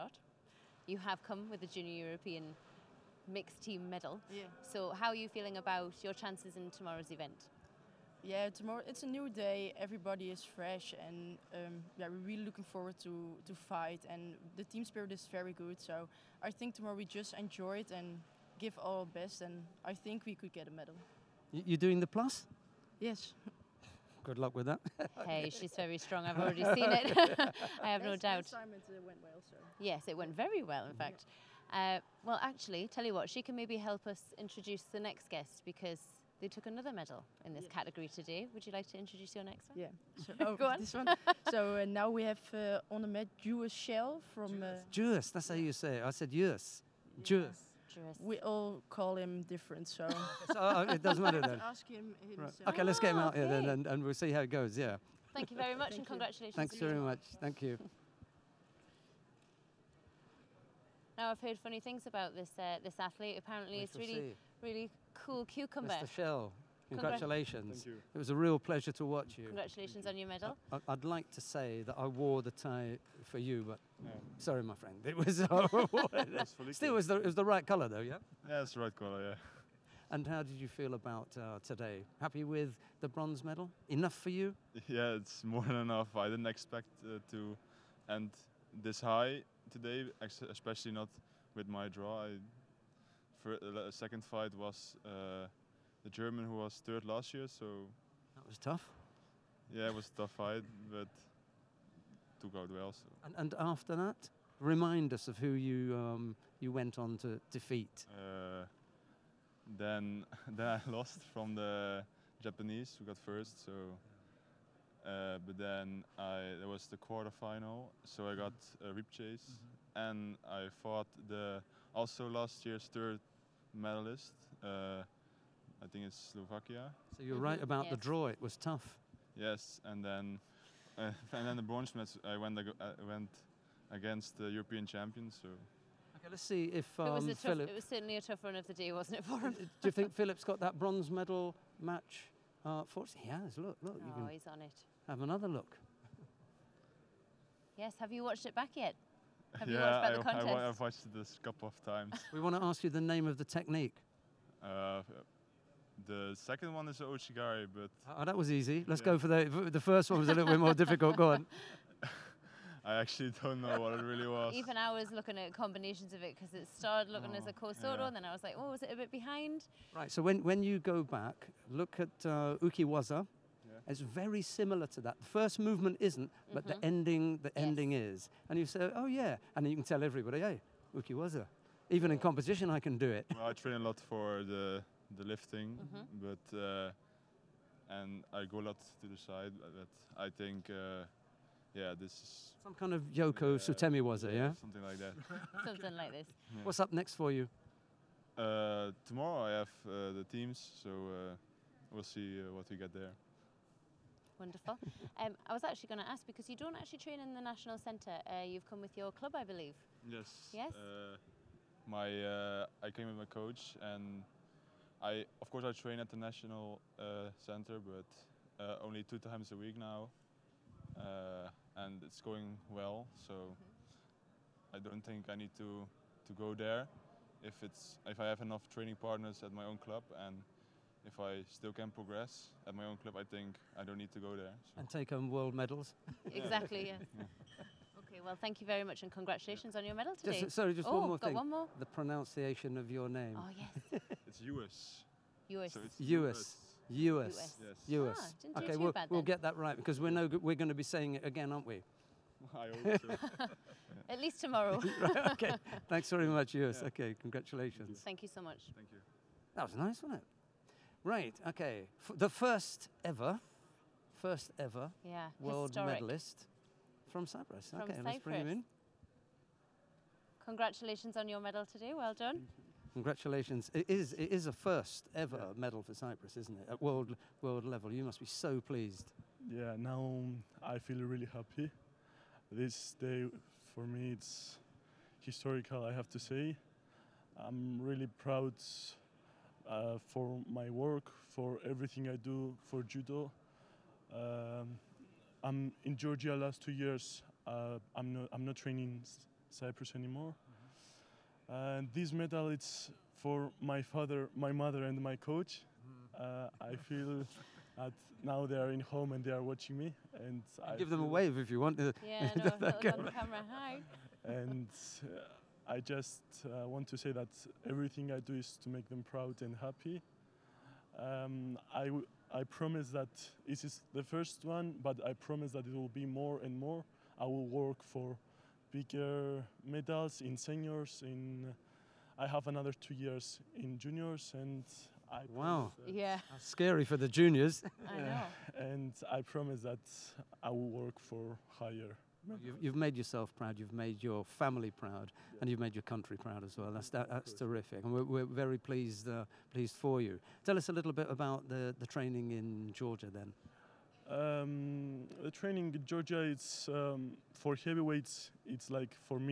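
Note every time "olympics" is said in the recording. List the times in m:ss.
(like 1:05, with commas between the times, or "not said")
not said.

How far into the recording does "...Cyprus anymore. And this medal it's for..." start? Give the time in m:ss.
4:59.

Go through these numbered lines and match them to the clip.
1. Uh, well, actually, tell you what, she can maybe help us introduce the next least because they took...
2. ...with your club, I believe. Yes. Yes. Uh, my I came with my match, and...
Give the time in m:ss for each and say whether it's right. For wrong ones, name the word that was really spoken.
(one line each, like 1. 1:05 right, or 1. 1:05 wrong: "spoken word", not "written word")
1. 0:31 wrong: "guest", not "least"
2. 3:28 wrong: "coach", not "match".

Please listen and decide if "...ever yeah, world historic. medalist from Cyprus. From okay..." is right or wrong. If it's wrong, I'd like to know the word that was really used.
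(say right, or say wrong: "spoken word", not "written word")
right.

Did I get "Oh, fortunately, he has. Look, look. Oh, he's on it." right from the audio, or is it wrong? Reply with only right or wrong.
right.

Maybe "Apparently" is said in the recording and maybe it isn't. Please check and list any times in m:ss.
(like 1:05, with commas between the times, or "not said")
1:03.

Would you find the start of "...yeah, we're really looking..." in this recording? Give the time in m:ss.
0:11.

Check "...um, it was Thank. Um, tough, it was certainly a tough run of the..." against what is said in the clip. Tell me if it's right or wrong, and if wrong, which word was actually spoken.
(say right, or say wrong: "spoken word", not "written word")
wrong: "Philip", not "Thank".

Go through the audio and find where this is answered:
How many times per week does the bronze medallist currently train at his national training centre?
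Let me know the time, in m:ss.
3:39.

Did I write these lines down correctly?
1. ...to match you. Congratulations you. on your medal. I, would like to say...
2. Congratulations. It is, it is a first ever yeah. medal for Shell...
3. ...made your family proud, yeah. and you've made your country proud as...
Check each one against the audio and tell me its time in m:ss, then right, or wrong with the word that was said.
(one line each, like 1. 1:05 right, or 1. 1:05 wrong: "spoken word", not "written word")
1. 1:08 wrong: "watch", not "match"
2. 4:32 wrong: "Cyprus", not "Shell"
3. 5:43 right.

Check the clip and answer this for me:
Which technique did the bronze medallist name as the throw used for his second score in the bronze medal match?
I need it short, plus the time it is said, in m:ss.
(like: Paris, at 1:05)
Ouchigari, at 2:36.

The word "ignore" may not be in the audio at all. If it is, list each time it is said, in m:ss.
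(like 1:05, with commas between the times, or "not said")
not said.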